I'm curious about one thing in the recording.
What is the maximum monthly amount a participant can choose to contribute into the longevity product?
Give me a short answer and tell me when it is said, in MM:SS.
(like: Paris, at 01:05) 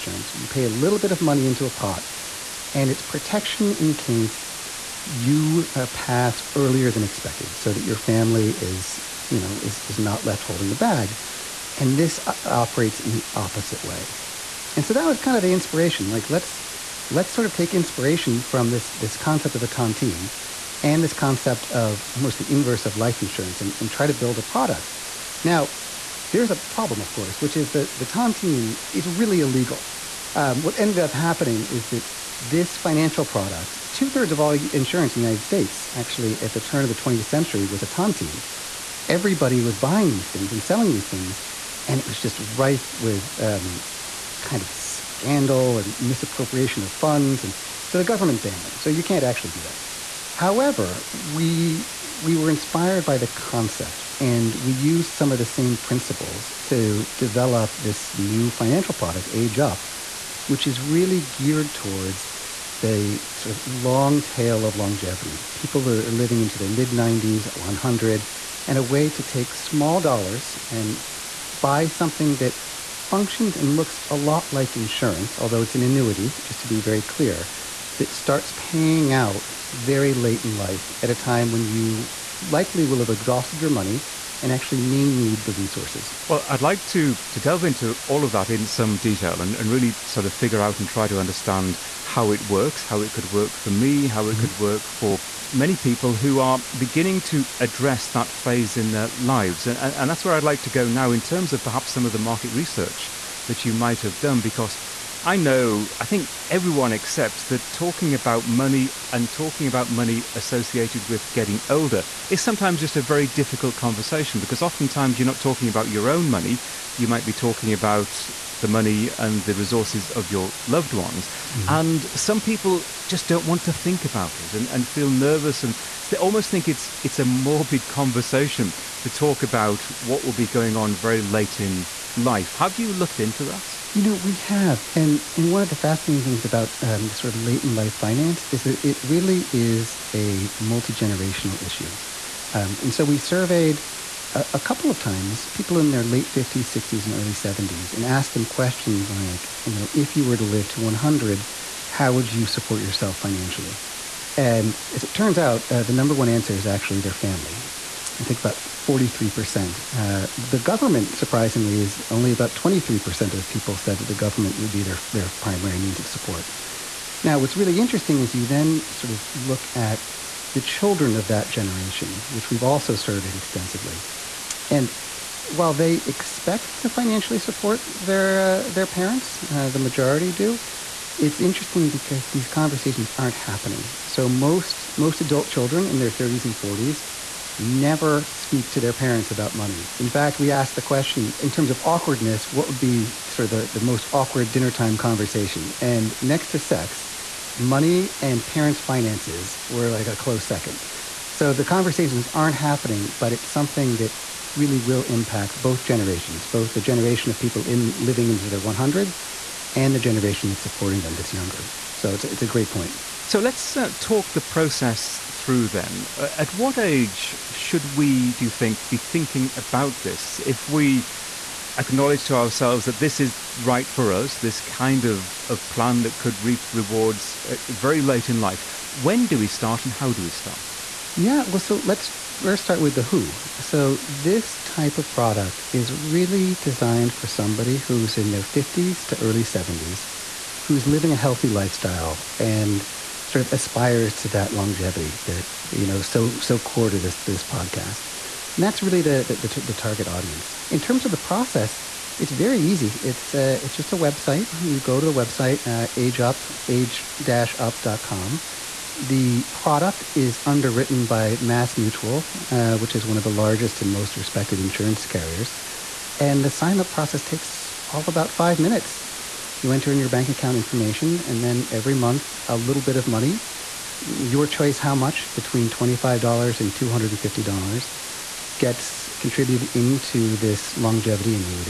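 $250, at 04:36.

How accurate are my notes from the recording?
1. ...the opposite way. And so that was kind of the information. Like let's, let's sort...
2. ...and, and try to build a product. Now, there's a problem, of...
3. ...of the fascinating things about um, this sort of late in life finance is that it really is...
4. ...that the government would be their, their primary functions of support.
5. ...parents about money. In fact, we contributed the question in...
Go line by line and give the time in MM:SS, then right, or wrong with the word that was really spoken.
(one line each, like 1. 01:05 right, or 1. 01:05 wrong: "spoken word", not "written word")
1. 00:13 wrong: "inspiration", not "information"
2. 00:23 right
3. 02:15 right
4. 02:43 wrong: "means", not "functions"
5. 03:08 wrong: "asked", not "contributed".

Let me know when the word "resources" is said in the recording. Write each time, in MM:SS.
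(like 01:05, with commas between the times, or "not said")
01:25, 01:59.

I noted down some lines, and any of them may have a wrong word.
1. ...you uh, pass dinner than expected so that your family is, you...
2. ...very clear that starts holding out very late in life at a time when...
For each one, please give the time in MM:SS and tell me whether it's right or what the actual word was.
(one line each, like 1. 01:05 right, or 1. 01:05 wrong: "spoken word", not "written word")
1. 00:05 wrong: "earlier", not "dinner"
2. 01:16 wrong: "paying", not "holding".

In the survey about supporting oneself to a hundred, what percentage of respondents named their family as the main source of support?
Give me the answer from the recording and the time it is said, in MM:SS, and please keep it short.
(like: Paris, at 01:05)
43%, at 02:38.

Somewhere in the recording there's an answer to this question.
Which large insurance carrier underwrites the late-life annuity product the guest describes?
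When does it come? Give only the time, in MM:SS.
04:21.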